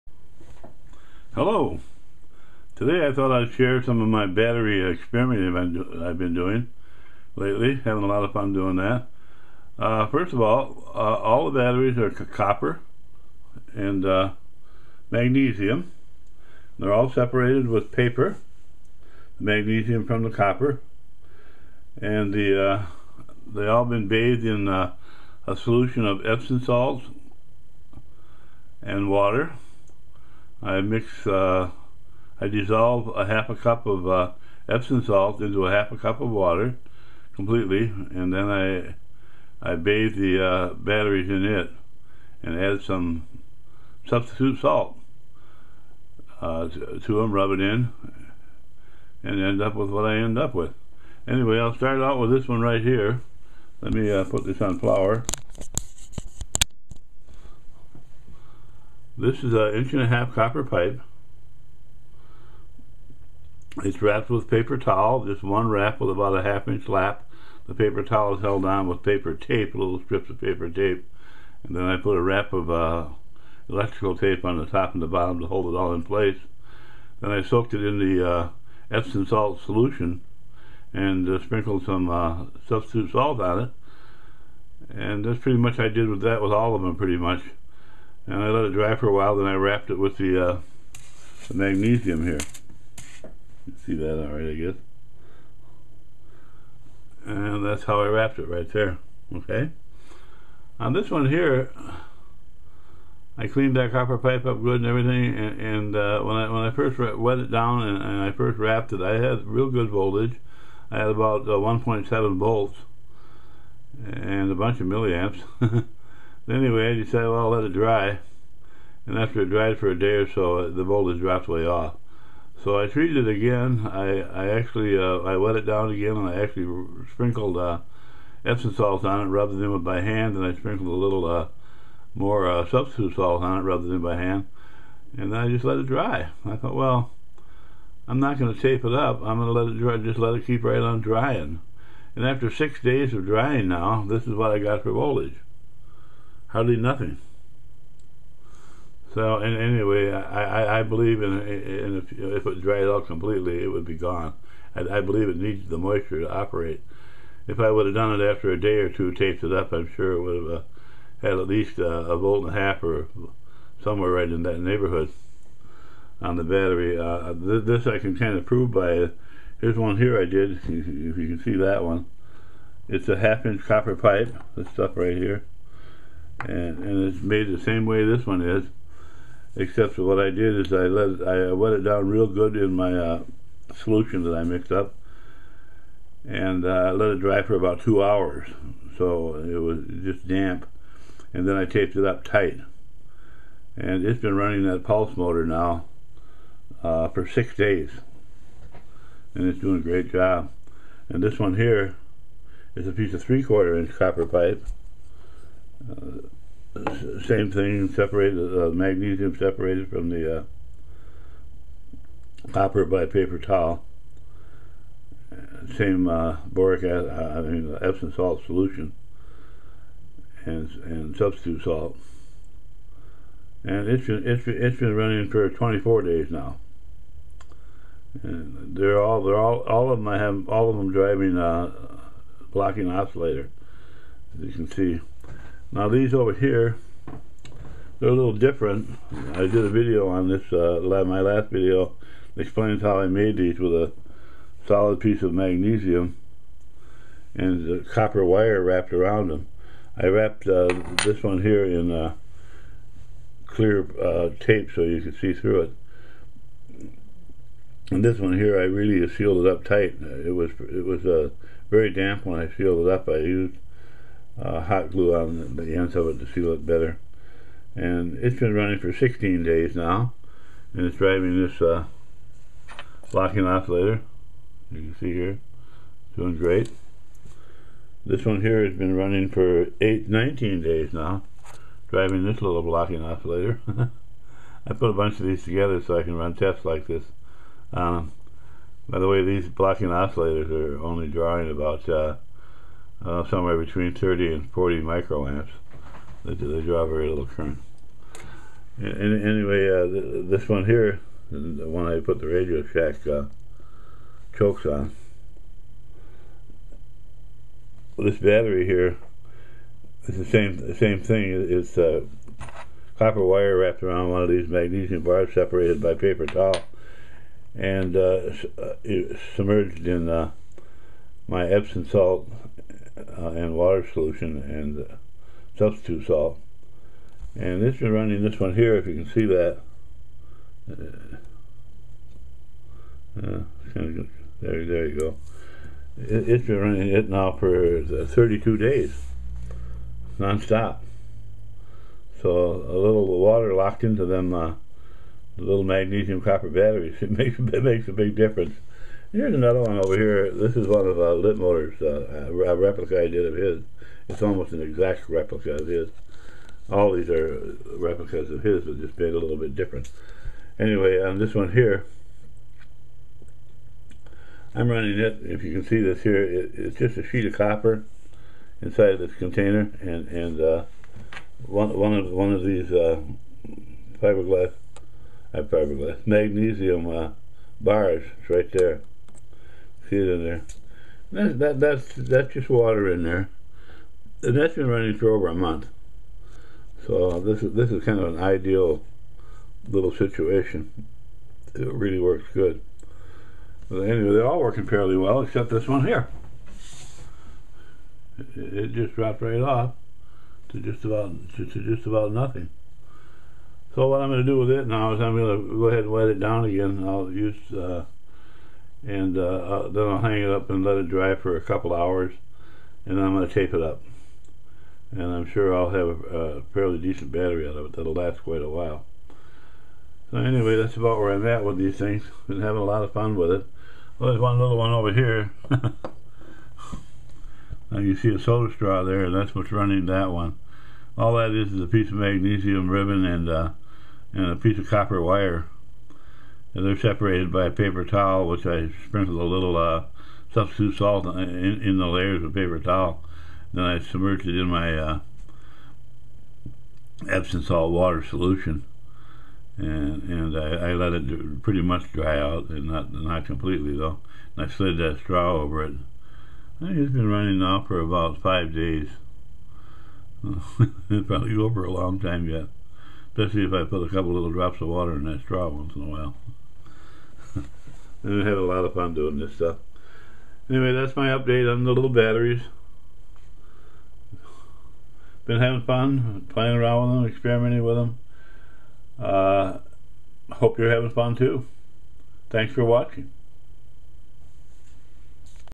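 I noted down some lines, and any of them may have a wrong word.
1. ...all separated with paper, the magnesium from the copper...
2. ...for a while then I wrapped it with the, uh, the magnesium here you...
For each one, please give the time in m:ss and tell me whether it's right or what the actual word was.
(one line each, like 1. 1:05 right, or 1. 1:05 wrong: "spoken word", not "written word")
1. 0:16 right
2. 1:28 right.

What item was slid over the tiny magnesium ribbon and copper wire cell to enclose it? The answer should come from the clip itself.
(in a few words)
soda straw.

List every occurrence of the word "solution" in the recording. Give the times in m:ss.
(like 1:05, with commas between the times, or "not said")
0:25, 1:19, 3:03, 3:38, 5:23, 7:28.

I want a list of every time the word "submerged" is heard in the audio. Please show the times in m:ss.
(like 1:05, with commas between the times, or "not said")
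5:19, 7:23.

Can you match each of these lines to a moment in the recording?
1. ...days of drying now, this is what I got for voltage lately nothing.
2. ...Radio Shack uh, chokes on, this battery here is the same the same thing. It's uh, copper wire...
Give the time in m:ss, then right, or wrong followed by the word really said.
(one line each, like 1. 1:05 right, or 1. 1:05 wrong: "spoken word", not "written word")
1. 2:22 wrong: "hardly", not "lately"
2. 5:02 right.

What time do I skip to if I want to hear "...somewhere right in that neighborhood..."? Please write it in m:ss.
2:43.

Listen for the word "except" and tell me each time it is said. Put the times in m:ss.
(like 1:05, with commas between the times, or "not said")
2:59, 6:35.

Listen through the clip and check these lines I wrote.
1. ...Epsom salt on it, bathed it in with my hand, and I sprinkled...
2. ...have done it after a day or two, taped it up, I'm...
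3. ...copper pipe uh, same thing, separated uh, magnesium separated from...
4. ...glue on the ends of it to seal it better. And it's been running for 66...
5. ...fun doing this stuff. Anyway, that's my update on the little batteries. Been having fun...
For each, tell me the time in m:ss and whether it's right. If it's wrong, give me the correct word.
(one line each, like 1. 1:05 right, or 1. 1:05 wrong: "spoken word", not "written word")
1. 2:08 wrong: "rubbed", not "bathed"
2. 2:37 right
3. 3:23 right
4. 4:24 wrong: "16", not "66"
5. 7:48 right.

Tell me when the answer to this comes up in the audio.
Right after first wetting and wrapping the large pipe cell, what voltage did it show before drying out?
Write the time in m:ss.
1:51.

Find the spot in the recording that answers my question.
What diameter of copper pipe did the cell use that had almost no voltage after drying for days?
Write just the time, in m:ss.
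0:59.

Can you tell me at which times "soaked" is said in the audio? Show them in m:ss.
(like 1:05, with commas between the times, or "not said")
1:17.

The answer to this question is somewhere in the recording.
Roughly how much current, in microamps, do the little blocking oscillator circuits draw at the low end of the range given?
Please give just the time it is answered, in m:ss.
4:53.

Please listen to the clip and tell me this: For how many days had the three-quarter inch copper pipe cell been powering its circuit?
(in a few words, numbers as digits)
24 days.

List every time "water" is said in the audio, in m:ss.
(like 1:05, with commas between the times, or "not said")
0:29, 0:36, 5:23, 5:43, 6:22, 7:27, 7:44.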